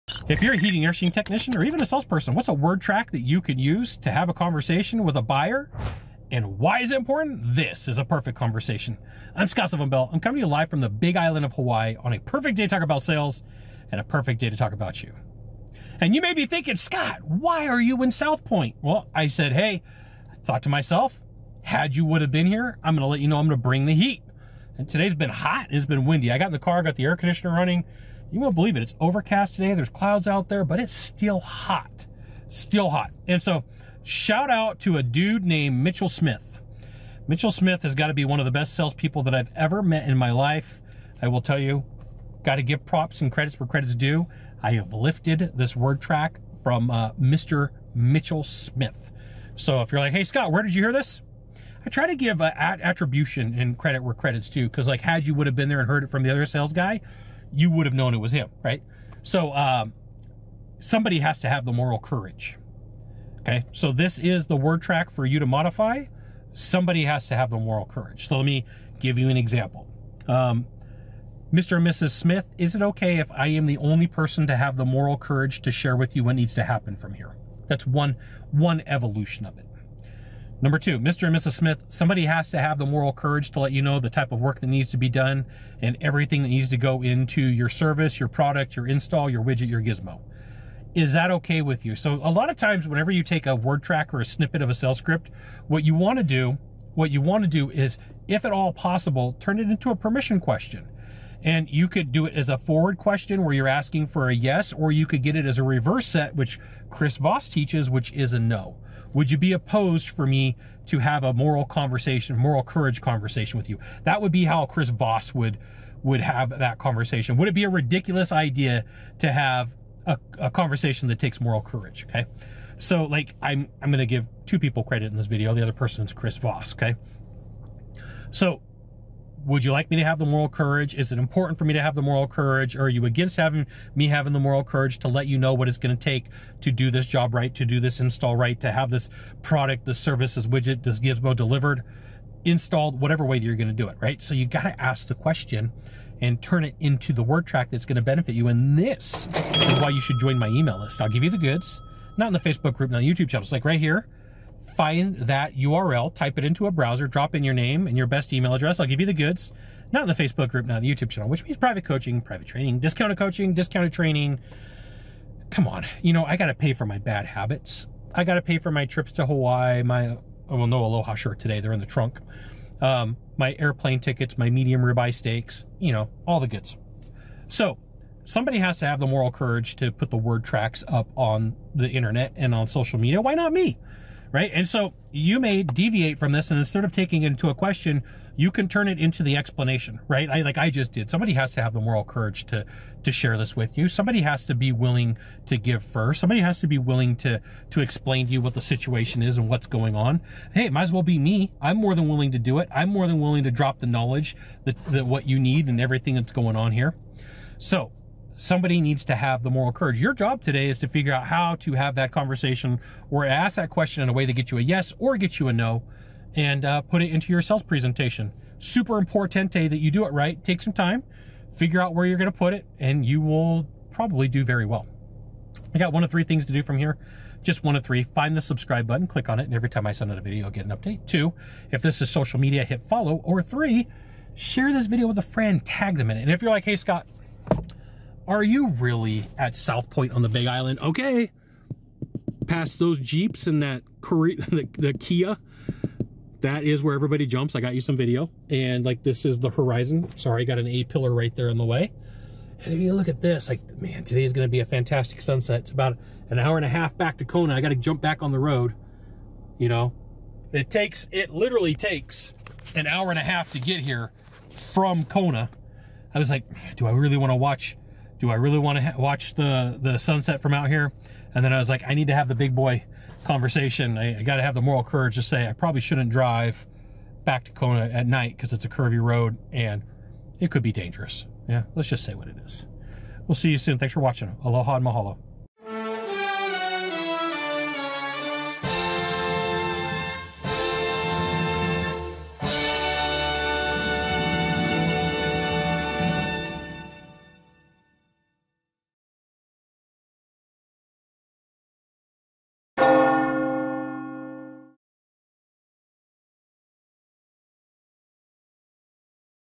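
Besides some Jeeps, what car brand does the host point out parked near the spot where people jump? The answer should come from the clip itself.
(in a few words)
Kia.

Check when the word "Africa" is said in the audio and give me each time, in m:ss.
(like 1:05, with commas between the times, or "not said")
not said.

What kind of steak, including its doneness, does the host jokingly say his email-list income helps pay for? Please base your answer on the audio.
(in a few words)
medium ribeye.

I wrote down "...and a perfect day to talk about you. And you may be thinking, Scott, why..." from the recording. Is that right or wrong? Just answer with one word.
right.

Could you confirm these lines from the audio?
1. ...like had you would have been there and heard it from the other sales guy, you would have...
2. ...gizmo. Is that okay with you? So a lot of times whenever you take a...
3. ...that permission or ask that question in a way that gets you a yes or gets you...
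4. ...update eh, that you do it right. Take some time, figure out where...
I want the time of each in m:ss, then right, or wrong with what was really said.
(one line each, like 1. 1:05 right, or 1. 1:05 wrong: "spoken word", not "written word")
1. 0:54 right
2. 1:29 right
3. 3:31 wrong: "conversation", not "permission"
4. 3:38 wrong: "importante", not "update".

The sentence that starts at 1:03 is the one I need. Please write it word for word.
Okay, so this is the word track for you to modify.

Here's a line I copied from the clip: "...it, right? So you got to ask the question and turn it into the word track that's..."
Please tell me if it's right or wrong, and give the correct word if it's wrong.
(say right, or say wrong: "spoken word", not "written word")
right.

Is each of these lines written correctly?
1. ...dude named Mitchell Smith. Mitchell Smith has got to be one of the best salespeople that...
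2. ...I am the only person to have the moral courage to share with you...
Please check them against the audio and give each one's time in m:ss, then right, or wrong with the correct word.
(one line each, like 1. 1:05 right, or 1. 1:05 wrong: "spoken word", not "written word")
1. 0:35 right
2. 1:13 right.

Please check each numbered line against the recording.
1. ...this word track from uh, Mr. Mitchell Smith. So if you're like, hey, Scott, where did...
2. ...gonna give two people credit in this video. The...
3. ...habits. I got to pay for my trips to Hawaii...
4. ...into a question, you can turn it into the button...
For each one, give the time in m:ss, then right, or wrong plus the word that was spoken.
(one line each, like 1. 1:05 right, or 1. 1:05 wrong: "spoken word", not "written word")
1. 0:45 right
2. 2:03 right
3. 2:47 right
4. 3:07 wrong: "explanation", not "button".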